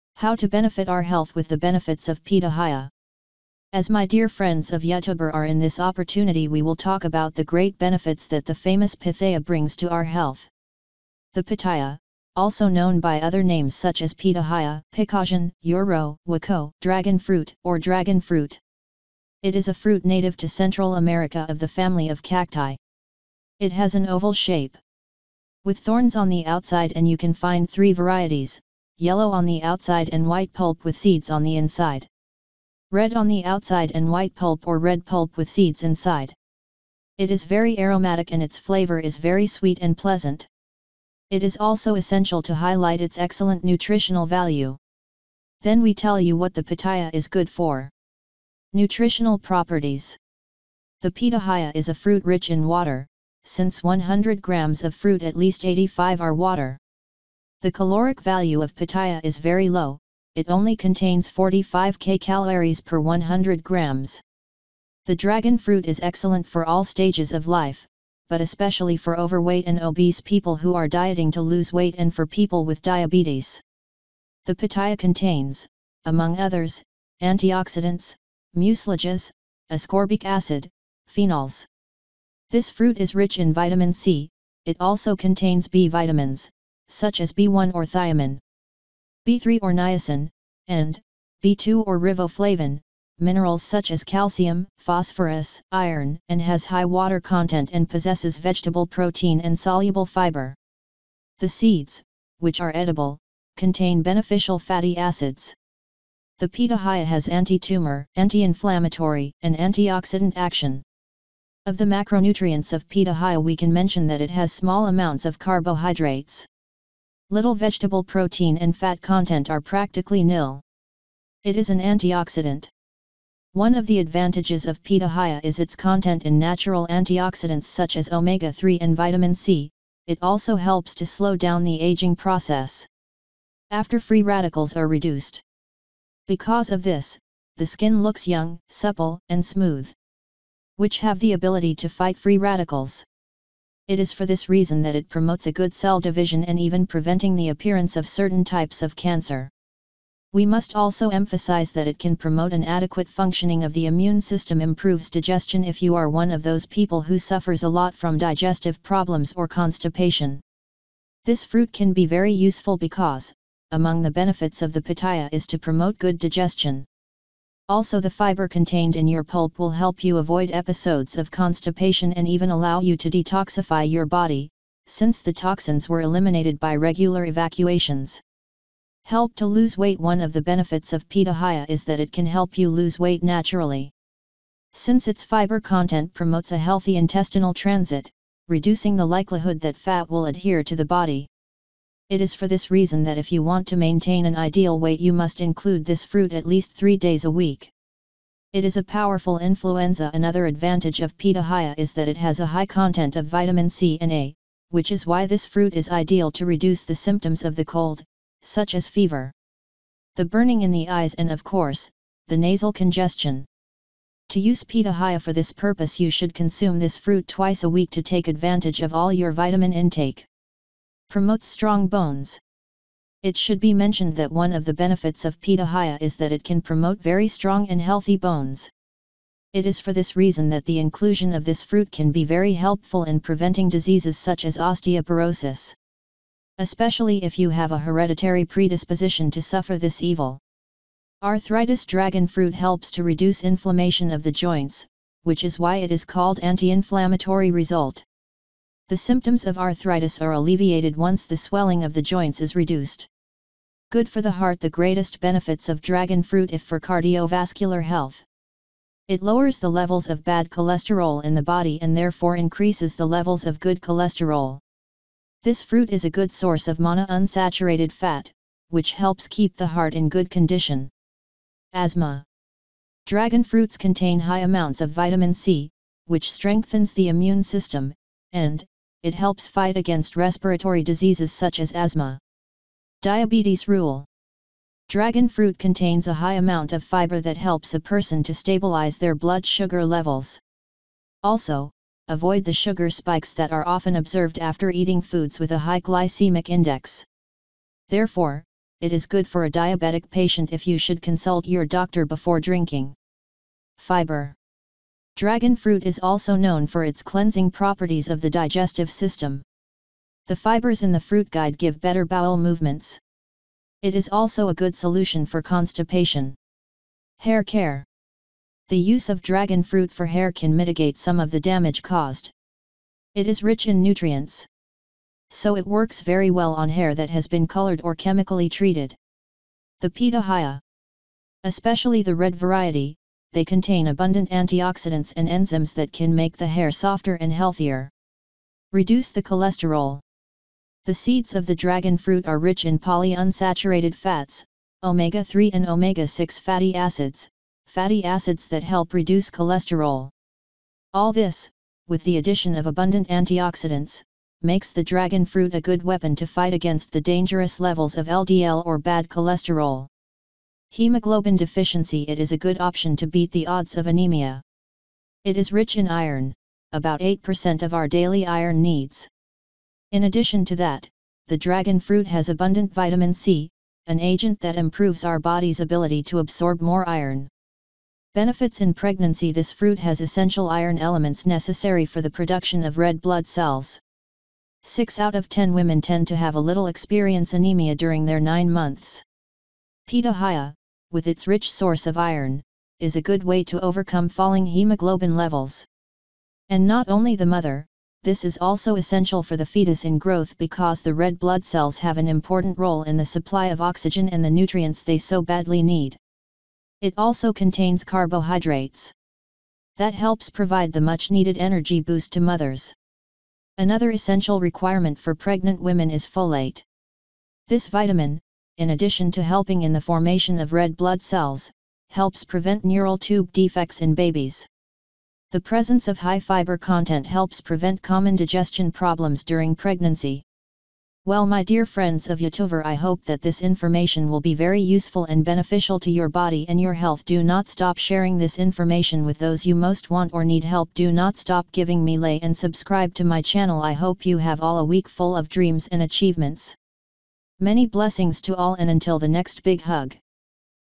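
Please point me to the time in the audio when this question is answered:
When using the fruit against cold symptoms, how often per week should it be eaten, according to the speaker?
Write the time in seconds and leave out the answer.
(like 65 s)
217 s.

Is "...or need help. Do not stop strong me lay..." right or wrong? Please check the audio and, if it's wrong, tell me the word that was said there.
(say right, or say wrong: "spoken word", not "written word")
wrong: "giving", not "strong".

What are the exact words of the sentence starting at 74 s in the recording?
The pitaya contains, among others, antioxidants, mucilages, ascorbic acid, phenols.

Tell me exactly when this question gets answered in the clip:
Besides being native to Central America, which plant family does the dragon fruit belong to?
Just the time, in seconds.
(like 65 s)
22 s.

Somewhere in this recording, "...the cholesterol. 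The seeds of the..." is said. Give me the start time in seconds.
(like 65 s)
339 s.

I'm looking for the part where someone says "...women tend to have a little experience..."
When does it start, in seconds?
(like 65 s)
385 s.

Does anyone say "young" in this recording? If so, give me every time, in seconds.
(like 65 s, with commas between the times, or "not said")
138 s.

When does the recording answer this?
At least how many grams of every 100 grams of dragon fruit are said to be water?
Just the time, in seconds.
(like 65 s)
55 s.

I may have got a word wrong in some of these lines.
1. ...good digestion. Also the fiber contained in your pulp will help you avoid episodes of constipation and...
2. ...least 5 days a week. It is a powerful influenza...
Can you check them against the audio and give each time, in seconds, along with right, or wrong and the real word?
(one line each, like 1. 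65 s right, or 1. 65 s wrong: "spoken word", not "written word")
1. 165 s right
2. 196 s wrong: "3", not "5".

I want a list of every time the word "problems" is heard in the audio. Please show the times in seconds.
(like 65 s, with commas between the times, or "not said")
158 s, 428 s.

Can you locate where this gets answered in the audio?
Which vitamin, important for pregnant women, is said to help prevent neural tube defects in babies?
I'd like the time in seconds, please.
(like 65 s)
416 s.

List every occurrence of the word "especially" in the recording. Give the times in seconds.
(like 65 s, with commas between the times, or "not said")
68 s, 236 s, 331 s.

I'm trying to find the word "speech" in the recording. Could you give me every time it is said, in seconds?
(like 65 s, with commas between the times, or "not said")
not said.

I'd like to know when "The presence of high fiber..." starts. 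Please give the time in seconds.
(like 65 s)
425 s.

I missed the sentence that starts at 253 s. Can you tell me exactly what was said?
Good for the heart The greatest benefits of dragon fruit if for cardiovascular health.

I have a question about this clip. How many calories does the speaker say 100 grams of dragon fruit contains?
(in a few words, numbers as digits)
45.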